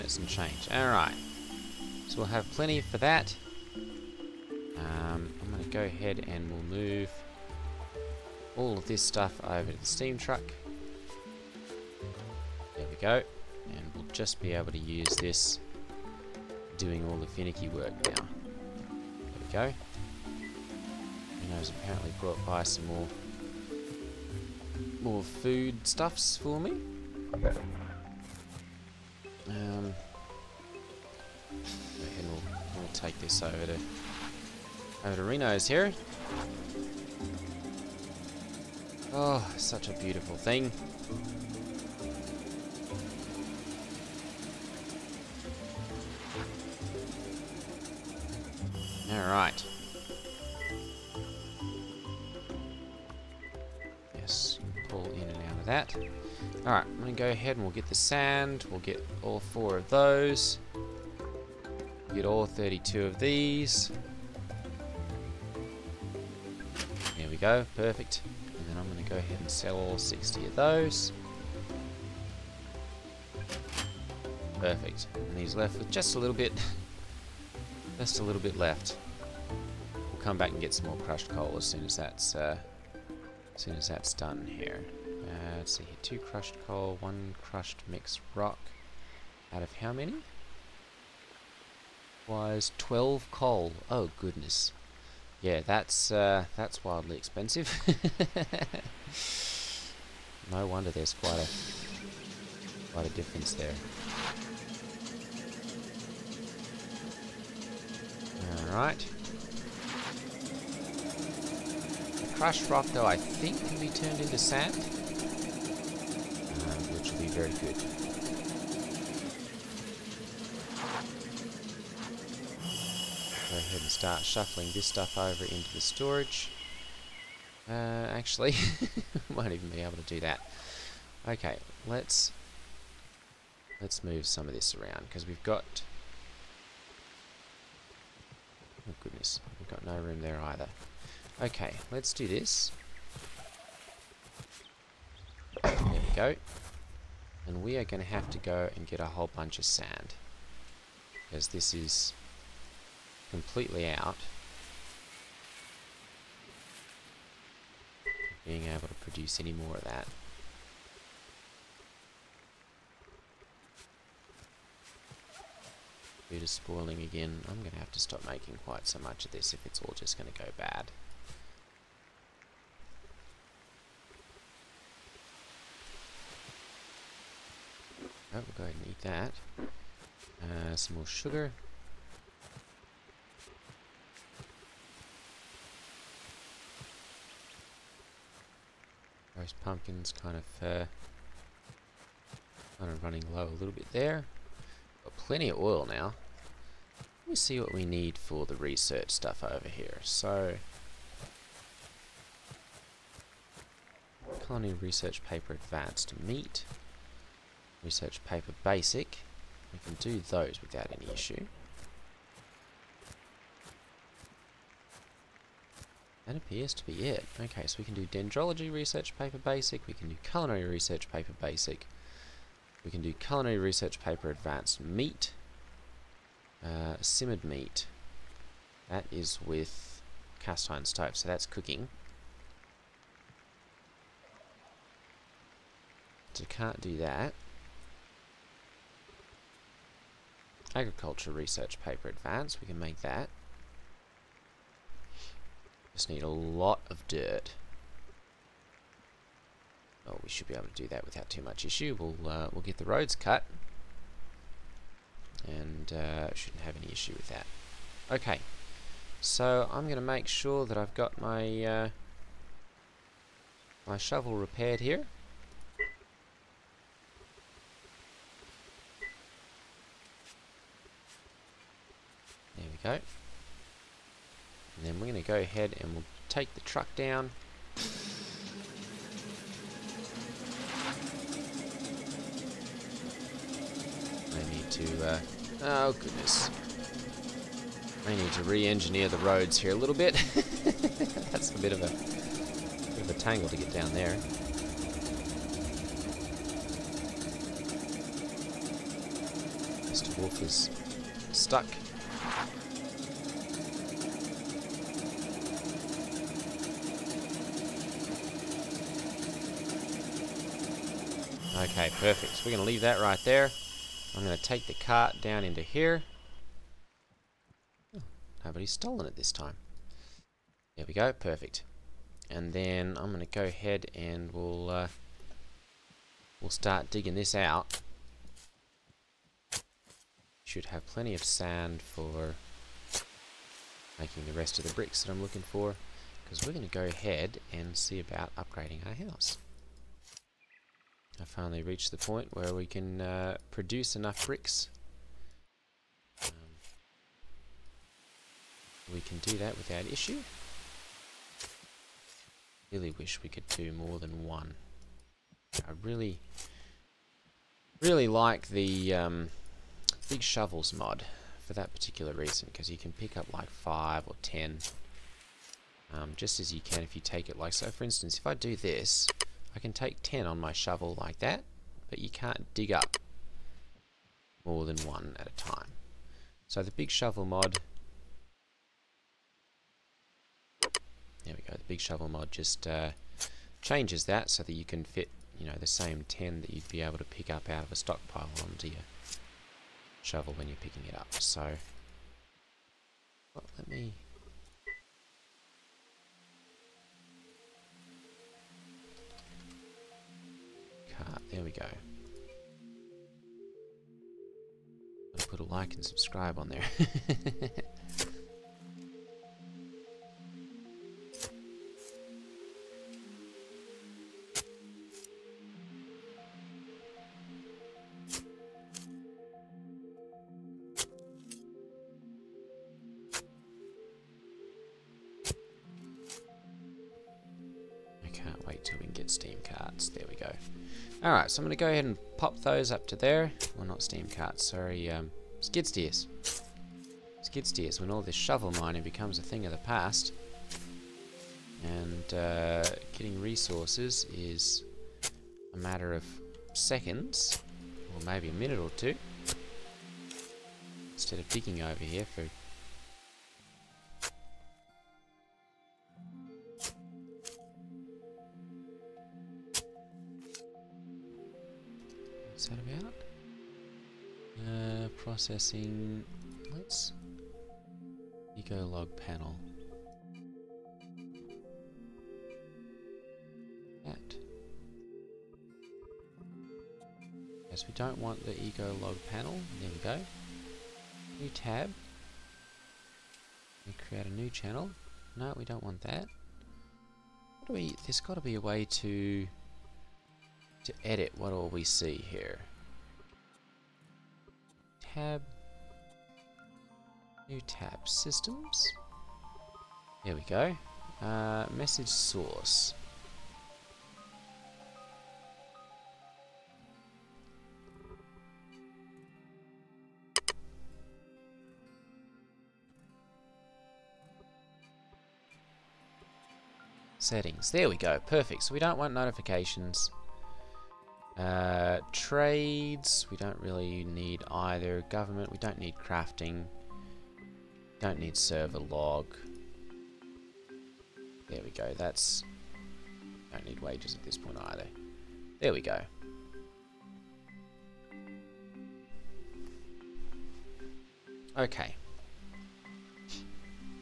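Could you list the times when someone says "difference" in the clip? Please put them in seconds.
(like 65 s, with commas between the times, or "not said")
103 s.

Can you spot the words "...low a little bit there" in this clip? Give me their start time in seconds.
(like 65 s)
193 s.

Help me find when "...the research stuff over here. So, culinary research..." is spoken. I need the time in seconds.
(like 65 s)
198 s.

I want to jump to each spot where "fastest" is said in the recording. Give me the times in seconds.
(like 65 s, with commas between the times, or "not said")
not said.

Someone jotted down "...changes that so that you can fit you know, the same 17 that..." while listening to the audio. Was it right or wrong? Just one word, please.
wrong.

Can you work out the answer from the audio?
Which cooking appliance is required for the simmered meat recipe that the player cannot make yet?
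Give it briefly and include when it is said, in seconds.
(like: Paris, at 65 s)
cast iron stove, at 230 s.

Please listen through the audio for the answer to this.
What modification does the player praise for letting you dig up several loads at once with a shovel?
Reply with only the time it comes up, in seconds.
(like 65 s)
360 s.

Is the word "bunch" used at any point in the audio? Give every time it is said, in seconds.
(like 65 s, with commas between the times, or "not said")
149 s.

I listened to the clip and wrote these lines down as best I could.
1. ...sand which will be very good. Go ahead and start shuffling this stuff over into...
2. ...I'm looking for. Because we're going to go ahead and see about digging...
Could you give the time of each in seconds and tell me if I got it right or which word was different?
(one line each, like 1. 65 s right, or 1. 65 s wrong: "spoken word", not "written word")
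1. 114 s right
2. 335 s wrong: "upgrading", not "digging".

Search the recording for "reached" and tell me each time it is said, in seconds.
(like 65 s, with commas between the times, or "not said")
341 s.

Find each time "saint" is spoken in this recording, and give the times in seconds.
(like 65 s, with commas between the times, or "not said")
not said.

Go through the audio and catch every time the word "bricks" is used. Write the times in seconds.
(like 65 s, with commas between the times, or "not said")
334 s, 344 s.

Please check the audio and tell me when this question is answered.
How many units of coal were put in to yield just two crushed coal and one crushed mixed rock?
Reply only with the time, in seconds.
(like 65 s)
92 s.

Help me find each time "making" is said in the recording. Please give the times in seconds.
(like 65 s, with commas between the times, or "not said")
168 s, 333 s.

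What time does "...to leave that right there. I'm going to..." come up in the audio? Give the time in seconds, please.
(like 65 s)
312 s.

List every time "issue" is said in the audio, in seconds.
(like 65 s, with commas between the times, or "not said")
211 s, 251 s, 256 s, 349 s.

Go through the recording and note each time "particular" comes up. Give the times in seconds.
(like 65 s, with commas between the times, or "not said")
361 s.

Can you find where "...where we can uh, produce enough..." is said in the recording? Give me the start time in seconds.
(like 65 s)
342 s.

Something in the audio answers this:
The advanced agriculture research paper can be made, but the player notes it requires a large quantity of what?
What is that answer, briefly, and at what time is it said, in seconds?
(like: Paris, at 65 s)
dirt, at 247 s.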